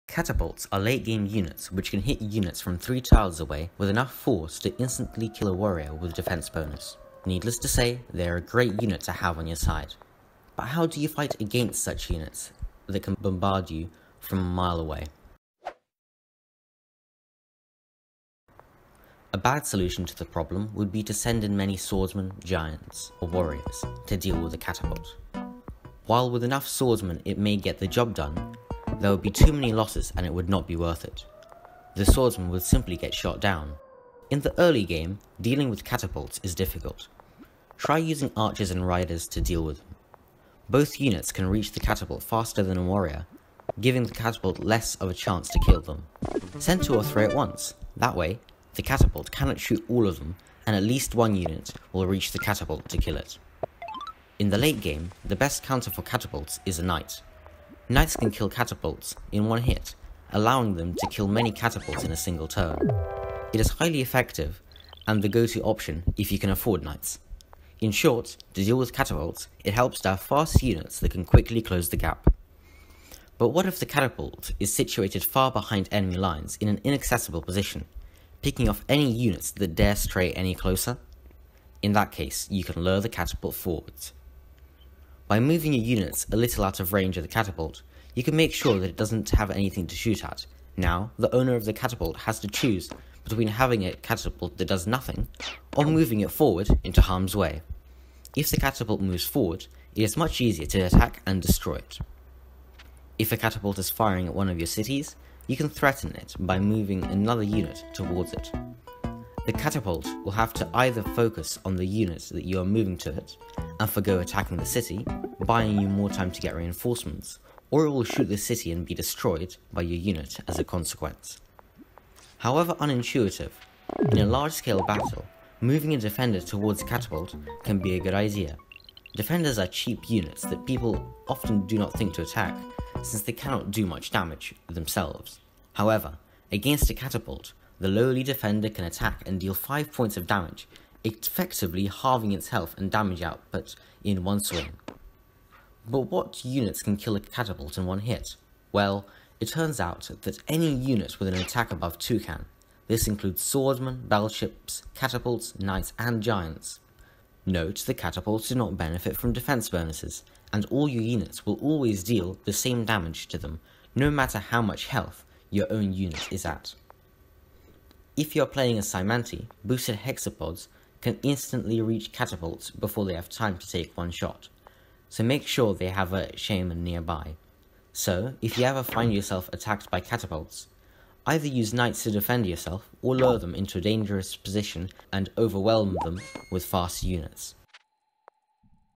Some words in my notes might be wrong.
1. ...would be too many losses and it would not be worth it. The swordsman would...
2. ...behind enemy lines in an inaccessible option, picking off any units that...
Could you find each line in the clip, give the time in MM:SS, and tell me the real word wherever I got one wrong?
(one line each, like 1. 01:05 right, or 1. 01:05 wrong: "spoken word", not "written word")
1. 00:29 right
2. 01:15 wrong: "position", not "option".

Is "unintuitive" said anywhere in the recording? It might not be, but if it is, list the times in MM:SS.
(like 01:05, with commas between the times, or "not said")
02:02.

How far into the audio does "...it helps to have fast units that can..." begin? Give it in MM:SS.
01:09.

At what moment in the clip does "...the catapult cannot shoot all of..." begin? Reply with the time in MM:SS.
00:48.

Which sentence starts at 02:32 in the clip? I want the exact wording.
This includes swordsmen, battleships, catapults, knights, and giants.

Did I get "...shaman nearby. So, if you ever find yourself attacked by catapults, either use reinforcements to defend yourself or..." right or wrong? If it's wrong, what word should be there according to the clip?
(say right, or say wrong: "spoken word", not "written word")
wrong: "knights", not "reinforcements".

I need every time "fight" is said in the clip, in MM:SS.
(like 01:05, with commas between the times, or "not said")
00:11.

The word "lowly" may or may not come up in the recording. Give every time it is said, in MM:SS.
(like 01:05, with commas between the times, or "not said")
02:17.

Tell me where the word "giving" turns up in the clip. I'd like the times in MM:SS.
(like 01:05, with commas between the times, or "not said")
00:43.